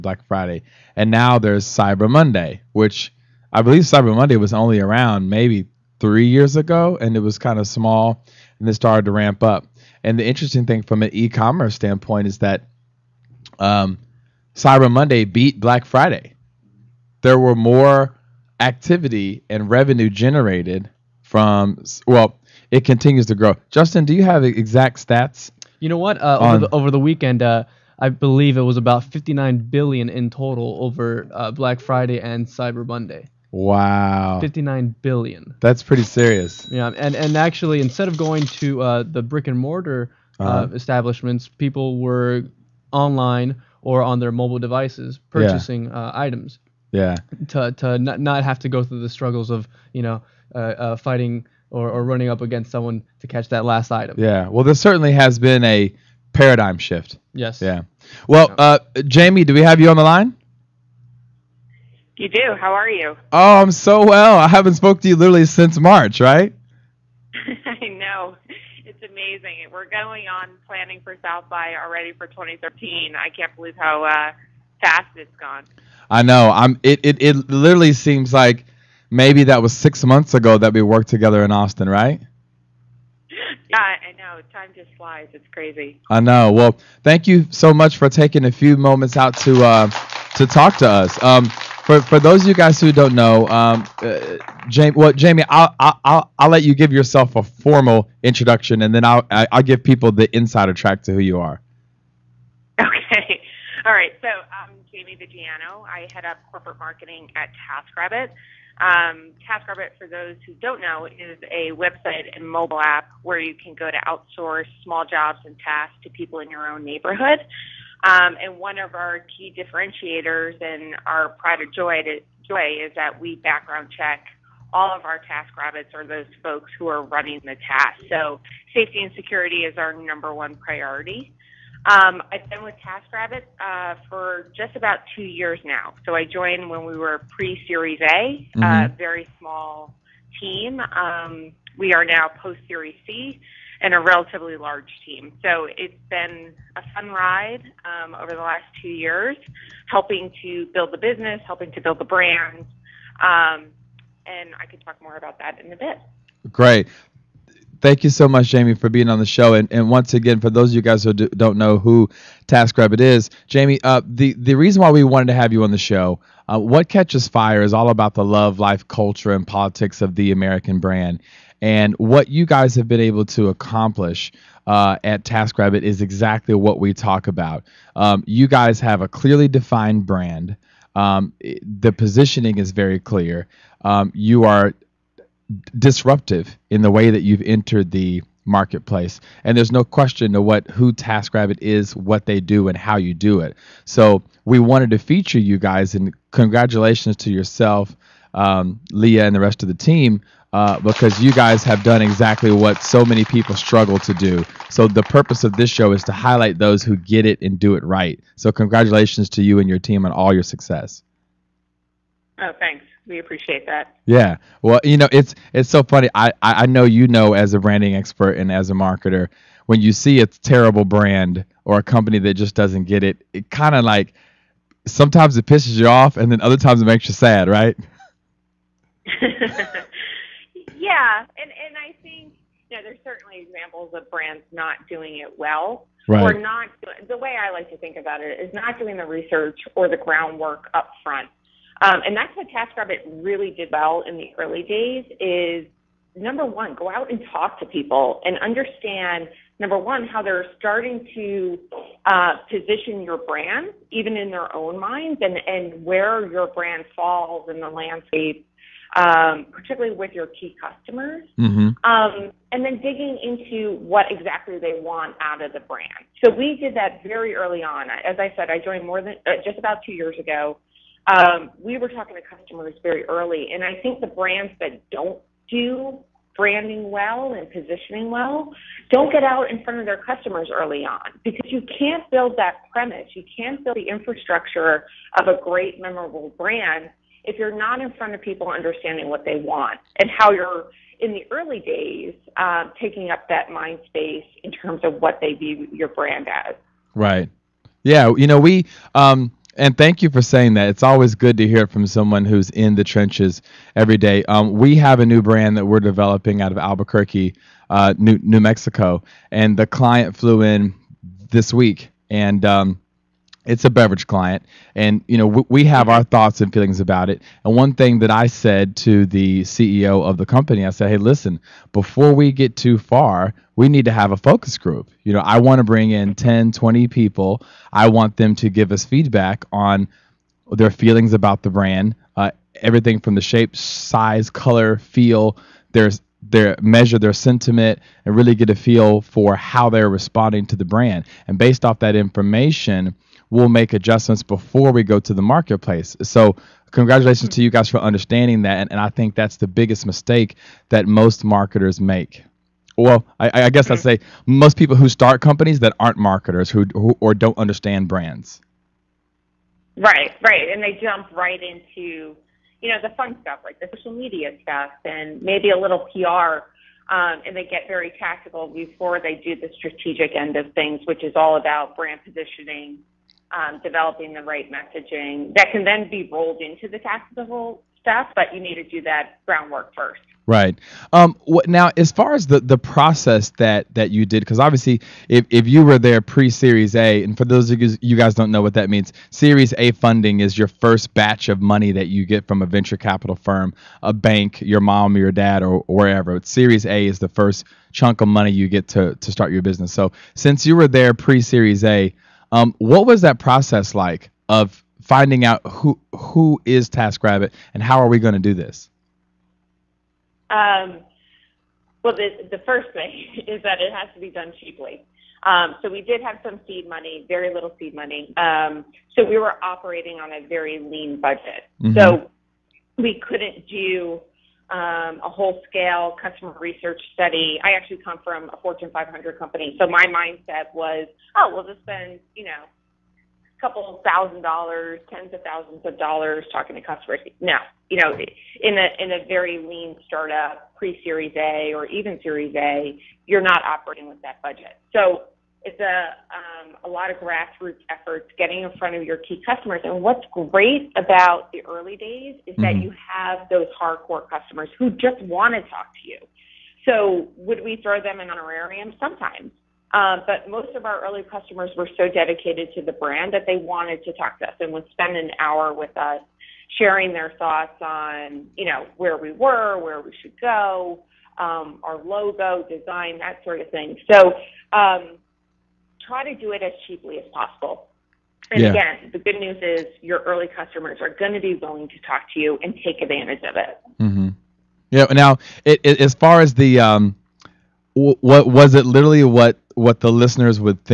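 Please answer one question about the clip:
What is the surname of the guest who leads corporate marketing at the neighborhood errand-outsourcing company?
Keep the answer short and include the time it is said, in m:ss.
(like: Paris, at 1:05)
Viggiano, at 1:45.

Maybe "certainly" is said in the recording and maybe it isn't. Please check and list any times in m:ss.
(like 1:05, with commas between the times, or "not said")
0:54, 3:53.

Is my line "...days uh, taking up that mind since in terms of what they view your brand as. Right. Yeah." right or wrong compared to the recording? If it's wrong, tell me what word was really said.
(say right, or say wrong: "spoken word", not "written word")
wrong: "space", not "since".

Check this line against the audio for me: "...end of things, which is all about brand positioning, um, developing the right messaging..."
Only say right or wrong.
right.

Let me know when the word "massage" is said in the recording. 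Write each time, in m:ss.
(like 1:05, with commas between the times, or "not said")
not said.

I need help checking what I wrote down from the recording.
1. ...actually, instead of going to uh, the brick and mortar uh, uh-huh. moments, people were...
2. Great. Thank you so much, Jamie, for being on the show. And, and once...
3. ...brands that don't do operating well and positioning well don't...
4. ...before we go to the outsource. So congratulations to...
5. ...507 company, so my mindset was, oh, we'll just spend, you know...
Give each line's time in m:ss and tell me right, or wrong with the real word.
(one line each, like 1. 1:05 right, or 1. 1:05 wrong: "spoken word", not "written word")
1. 0:37 wrong: "establishments", not "moments"
2. 2:36 right
3. 4:34 wrong: "branding", not "operating"
4. 5:44 wrong: "marketplace", not "outsource"
5. 7:08 wrong: "500", not "507".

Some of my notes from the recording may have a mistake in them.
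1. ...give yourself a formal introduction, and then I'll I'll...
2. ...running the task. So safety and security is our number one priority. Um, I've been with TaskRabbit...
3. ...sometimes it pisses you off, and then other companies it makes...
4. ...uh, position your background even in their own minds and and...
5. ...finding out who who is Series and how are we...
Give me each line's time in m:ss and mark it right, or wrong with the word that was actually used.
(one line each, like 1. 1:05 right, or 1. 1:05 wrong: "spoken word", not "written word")
1. 1:36 right
2. 2:07 right
3. 3:44 wrong: "times", not "companies"
4. 4:12 wrong: "brand", not "background"
5. 6:44 wrong: "TaskRabbit", not "Series".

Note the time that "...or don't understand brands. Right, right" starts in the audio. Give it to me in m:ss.
5:57.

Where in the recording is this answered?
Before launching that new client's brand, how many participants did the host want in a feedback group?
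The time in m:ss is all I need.
5:26.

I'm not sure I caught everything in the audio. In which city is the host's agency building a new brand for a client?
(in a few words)
Albuquerque.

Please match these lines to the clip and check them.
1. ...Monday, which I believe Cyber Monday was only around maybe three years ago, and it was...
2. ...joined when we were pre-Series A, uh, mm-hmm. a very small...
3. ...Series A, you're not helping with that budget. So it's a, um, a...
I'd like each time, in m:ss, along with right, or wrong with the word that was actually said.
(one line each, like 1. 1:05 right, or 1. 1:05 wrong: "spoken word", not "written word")
1. 0:02 right
2. 2:16 right
3. 7:22 wrong: "operating", not "helping".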